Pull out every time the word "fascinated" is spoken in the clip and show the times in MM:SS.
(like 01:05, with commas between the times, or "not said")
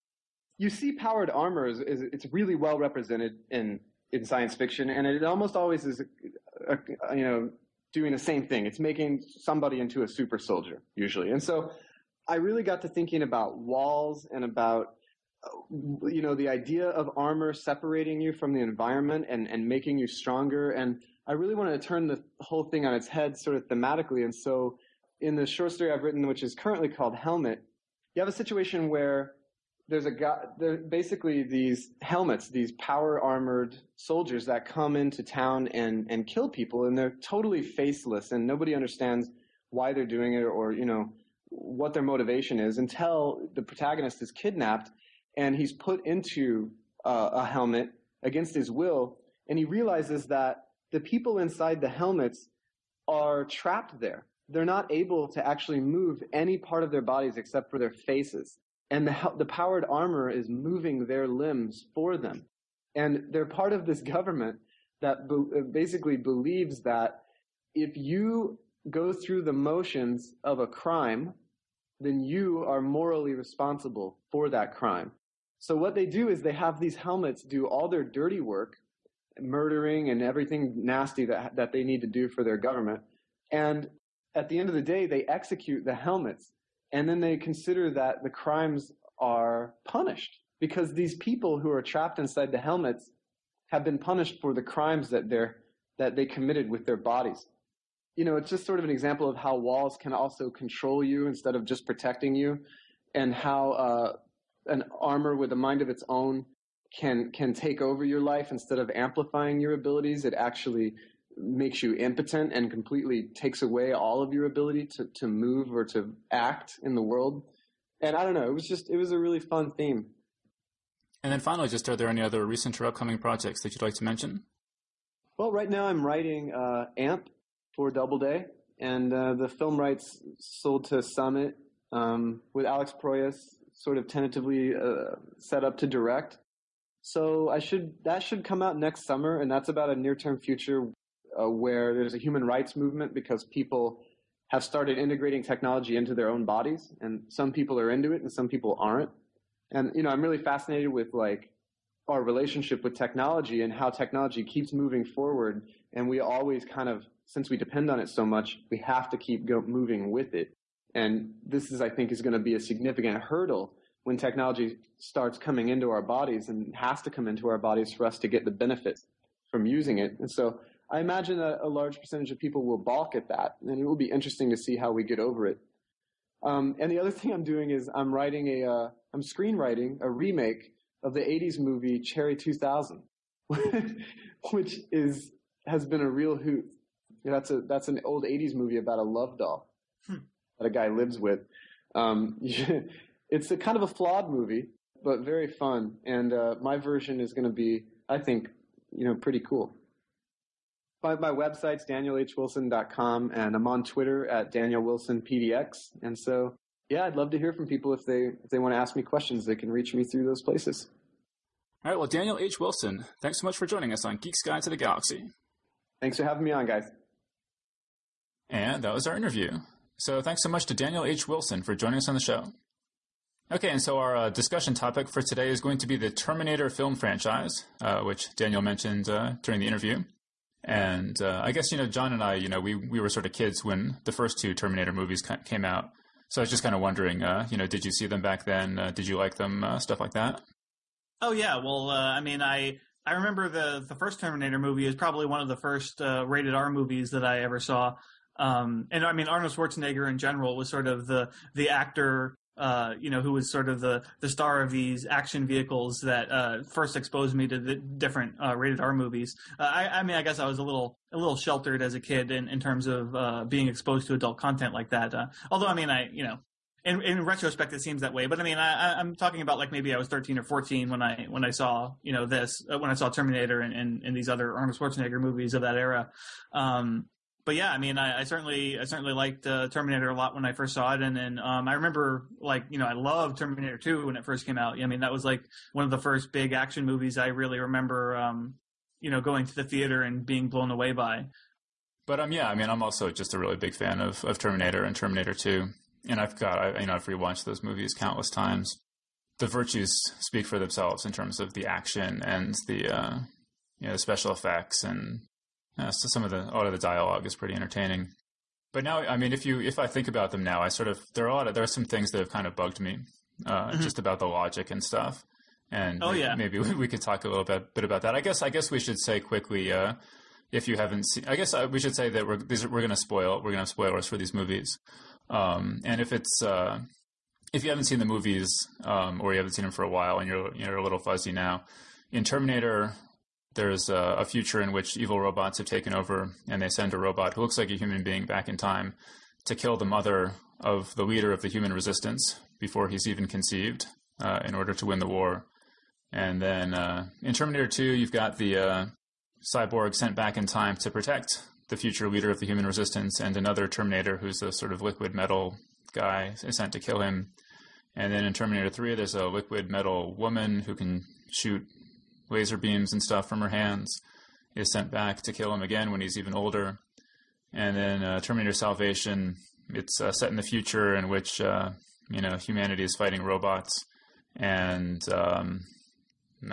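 02:30.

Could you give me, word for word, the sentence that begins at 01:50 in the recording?
It actually makes you impotent and completely takes away all of your ability to, to move or to act in the world.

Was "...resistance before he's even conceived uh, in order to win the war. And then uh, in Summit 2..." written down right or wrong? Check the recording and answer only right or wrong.
wrong.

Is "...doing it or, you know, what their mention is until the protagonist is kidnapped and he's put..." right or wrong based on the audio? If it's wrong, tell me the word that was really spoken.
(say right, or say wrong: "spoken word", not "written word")
wrong: "motivation", not "mention".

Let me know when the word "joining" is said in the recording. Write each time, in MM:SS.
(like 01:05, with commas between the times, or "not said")
03:33, 03:41.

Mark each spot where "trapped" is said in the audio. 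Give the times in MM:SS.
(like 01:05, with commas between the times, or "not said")
00:53, 01:31.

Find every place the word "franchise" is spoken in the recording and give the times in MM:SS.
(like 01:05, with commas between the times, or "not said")
03:46.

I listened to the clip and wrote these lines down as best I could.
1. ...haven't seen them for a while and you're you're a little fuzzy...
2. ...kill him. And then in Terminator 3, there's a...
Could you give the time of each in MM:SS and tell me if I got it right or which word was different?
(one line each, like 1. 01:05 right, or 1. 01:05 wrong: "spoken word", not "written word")
1. 05:29 right
2. 05:56 right.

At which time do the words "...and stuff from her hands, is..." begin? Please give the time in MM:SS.
06:02.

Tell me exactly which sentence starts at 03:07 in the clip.
That's a, that's an old 80s movie about a love doll hmm.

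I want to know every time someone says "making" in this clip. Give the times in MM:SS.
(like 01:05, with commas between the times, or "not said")
00:08, 00:19.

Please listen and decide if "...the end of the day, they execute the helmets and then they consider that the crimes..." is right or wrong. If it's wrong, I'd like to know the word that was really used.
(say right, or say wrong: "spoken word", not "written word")
right.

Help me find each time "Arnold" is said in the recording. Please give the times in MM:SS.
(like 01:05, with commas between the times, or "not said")
04:09, 04:34.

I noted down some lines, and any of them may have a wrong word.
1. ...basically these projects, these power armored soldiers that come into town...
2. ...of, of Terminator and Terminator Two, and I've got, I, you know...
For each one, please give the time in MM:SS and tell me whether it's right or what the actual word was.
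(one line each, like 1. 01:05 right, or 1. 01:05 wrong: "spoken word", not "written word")
1. 00:30 wrong: "helmets", not "projects"
2. 04:54 right.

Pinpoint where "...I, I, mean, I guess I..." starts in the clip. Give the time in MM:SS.
04:19.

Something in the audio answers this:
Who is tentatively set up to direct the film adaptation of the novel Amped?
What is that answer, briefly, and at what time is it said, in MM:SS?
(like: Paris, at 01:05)
Alex Proyas, at 02:12.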